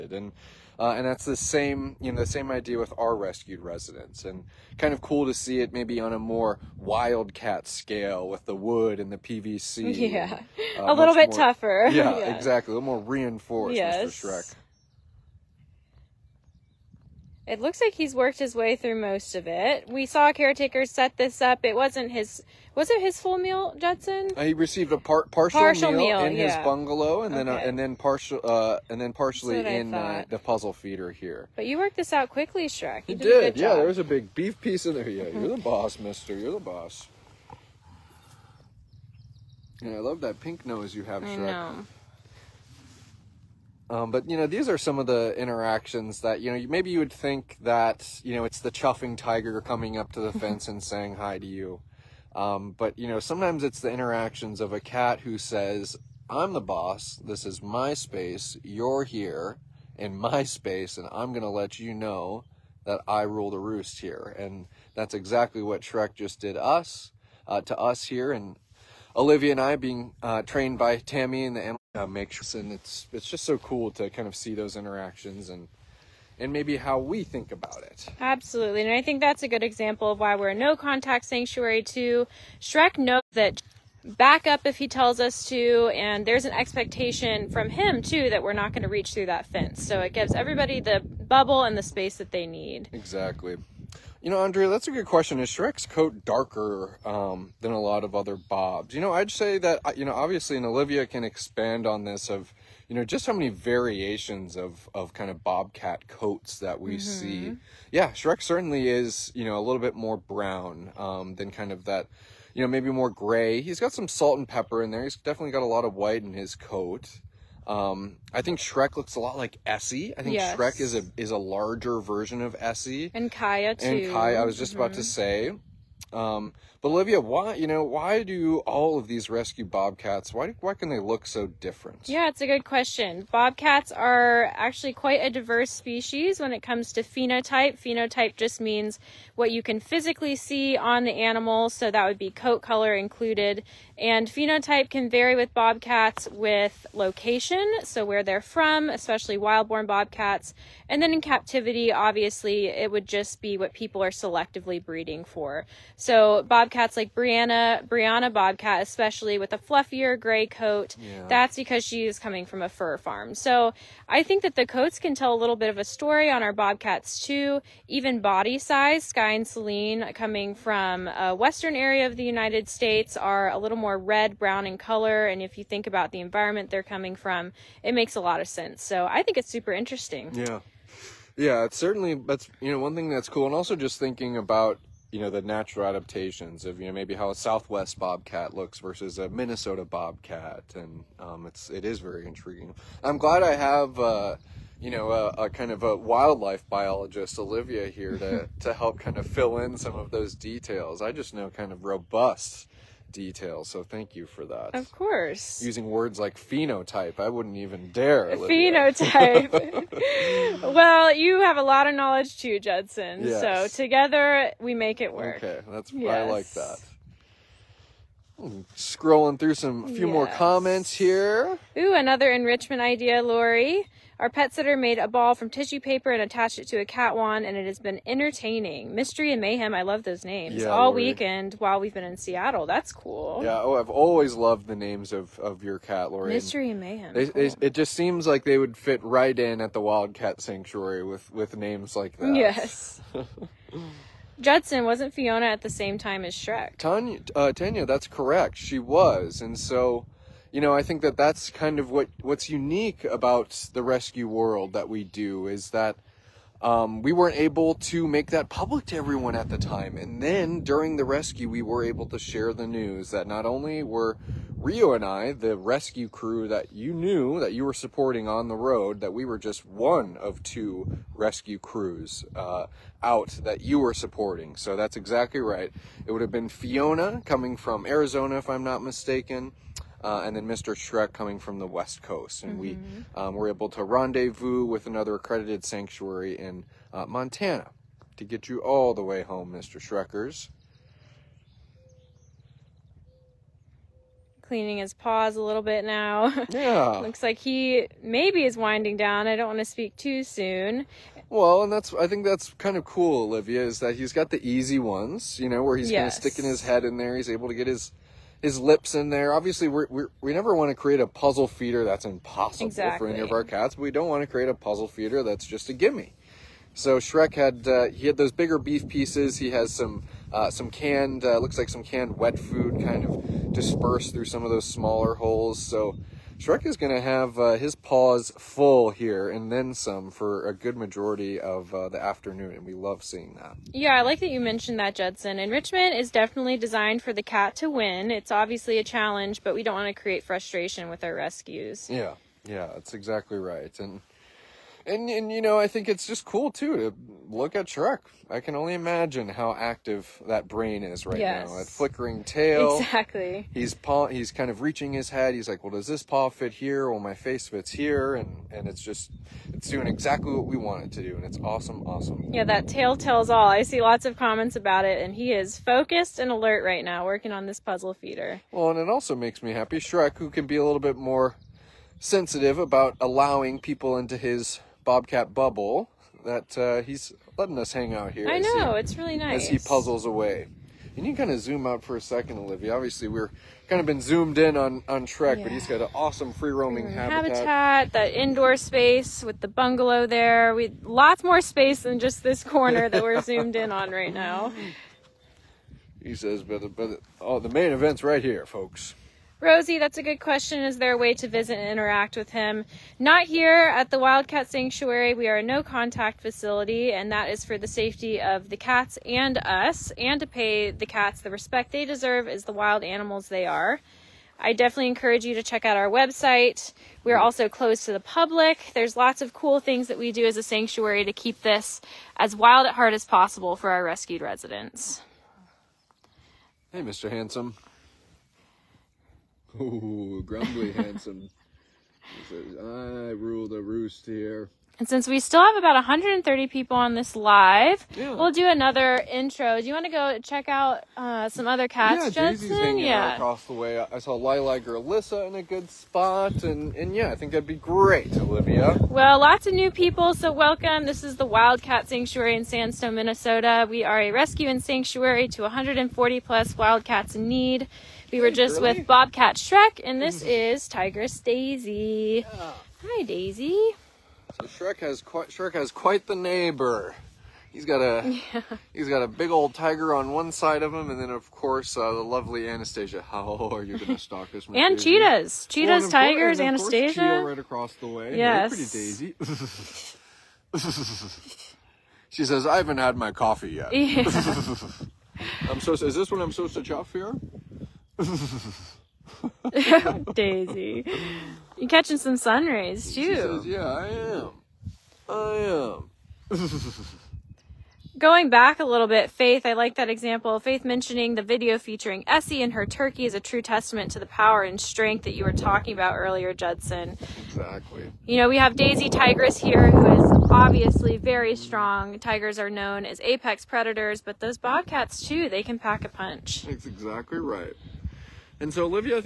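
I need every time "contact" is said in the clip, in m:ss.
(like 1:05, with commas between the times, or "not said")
1:20, 6:45.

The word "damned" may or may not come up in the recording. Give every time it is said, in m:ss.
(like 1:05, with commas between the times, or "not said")
not said.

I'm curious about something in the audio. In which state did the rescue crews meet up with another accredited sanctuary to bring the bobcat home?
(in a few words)
Montana.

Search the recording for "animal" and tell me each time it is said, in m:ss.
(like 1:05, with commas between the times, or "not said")
2:21, 6:52.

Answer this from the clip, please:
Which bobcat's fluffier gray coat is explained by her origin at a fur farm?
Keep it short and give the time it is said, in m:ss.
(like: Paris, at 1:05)
Brianna, at 2:37.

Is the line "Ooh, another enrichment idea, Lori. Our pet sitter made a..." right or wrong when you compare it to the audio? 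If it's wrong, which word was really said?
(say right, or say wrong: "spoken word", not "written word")
right.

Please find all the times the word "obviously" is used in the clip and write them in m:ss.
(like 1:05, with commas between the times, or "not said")
1:40, 2:31, 5:09, 5:38, 6:22, 8:30.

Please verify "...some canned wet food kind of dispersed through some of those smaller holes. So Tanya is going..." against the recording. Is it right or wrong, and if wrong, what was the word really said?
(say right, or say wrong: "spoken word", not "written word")
wrong: "Shrek", not "Tanya".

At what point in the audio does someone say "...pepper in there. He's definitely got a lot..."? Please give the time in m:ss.
1:54.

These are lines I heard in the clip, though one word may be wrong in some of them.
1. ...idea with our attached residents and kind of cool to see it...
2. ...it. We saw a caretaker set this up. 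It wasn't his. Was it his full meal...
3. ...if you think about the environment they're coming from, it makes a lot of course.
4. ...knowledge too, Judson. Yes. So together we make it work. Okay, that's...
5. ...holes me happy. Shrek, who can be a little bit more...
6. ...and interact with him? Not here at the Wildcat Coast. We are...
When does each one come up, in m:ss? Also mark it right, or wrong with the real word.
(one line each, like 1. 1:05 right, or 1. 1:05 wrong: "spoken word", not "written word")
1. 0:02 wrong: "rescued", not "attached"
2. 0:19 right
3. 2:55 wrong: "sense", not "course"
4. 3:31 right
5. 6:09 wrong: "makes", not "holes"
6. 6:41 wrong: "Sanctuary", not "Coast".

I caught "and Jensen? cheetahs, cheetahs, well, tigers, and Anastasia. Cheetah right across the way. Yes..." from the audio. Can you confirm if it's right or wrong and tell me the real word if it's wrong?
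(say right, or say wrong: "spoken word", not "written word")
wrong: "Daisy", not "Jensen".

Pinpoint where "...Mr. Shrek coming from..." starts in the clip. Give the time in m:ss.
4:40.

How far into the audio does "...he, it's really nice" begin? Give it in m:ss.
6:18.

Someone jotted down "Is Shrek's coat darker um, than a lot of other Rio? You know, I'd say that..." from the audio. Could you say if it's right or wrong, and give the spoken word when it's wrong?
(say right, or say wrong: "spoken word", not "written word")
wrong: "Bobs", not "Rio".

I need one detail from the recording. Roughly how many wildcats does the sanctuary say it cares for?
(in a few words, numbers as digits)
140 plus.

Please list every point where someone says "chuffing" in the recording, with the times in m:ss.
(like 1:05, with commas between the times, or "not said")
0:48.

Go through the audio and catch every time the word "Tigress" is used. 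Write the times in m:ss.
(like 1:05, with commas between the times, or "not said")
7:40, 8:28.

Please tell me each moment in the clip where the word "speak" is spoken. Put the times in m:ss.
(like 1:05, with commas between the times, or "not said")
4:59.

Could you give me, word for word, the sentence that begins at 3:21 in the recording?
I just know kind of robust detail.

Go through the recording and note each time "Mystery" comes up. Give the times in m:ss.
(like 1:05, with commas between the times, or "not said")
3:48, 3:56.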